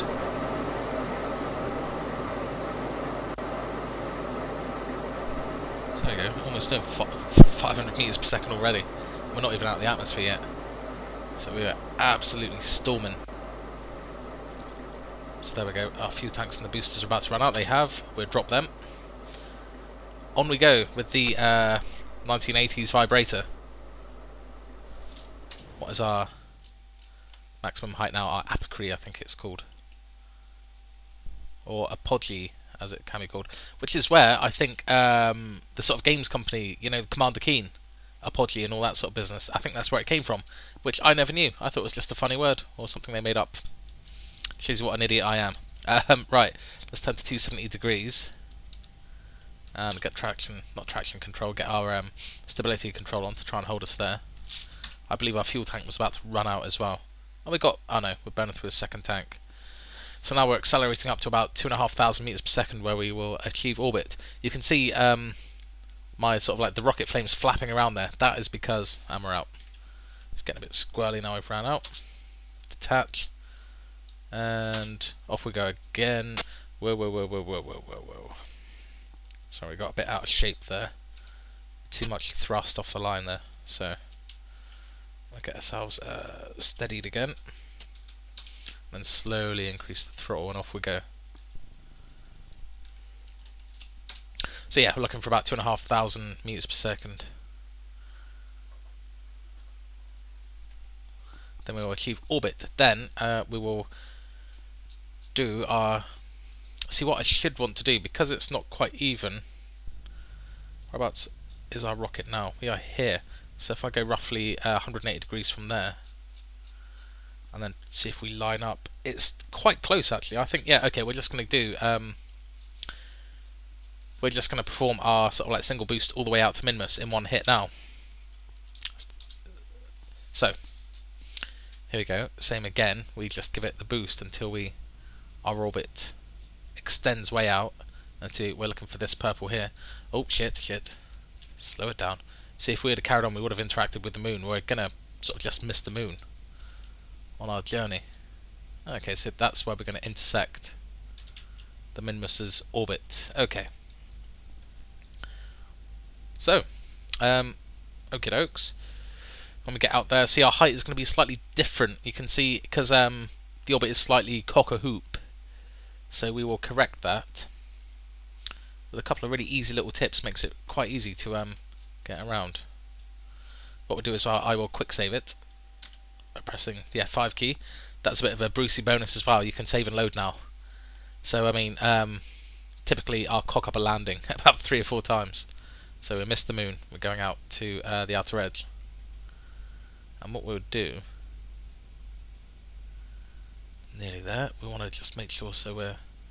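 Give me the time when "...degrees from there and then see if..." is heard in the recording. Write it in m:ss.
1:55.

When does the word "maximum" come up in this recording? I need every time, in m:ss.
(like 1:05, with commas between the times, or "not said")
0:27.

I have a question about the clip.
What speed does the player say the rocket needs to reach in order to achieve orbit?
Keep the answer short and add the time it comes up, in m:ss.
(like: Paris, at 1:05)
2,500 meters per second, at 1:01.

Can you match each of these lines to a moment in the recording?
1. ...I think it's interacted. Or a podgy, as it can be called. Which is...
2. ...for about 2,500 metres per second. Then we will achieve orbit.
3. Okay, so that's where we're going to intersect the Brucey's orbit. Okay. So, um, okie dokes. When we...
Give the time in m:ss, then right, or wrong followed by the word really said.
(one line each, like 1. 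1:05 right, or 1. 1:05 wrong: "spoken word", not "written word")
1. 0:28 wrong: "called", not "interacted"
2. 1:35 right
3. 2:28 wrong: "Minmus", not "Brucey".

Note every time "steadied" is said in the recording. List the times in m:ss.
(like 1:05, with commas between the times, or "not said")
1:26.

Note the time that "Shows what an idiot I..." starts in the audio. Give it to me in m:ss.
0:44.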